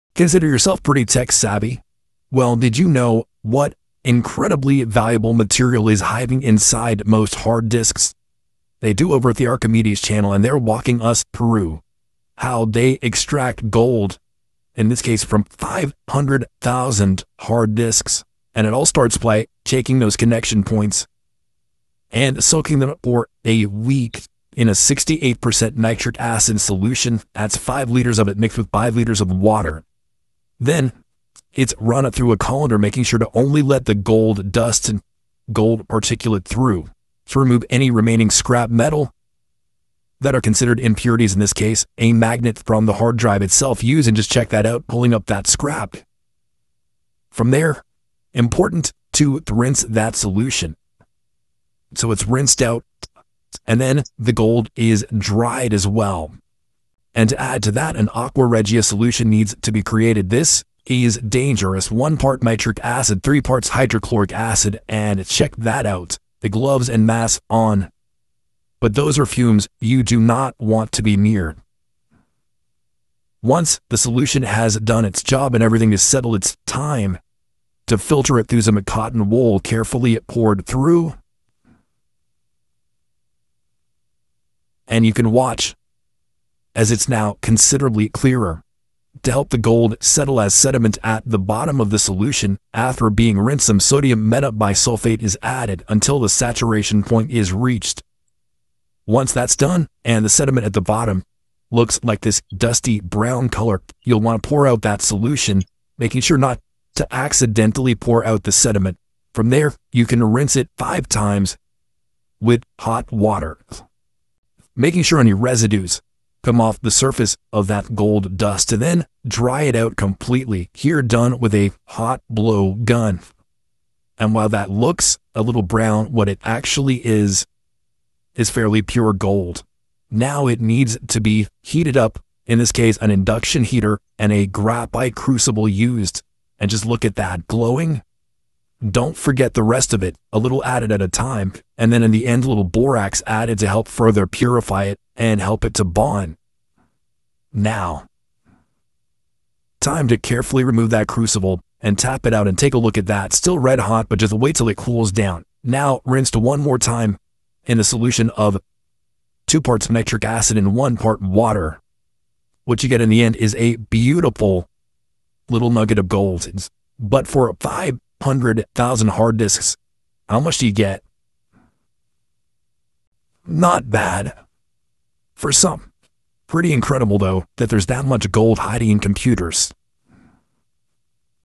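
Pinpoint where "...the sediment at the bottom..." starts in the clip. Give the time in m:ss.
1:40.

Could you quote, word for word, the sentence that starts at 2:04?
And while that looks a little brown, what it actually is, is fairly pure gold.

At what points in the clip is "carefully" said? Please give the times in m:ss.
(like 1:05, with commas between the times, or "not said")
1:19, 2:30.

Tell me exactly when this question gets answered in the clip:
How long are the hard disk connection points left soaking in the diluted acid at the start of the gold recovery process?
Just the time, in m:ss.
0:23.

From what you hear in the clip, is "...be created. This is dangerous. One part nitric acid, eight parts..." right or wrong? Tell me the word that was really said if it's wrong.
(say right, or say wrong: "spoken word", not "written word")
wrong: "three", not "eight".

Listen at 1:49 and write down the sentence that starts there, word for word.
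From there, you can rinse it five times with hot water.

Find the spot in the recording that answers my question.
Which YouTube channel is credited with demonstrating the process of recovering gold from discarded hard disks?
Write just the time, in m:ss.
0:09.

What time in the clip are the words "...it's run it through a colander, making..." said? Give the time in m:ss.
0:31.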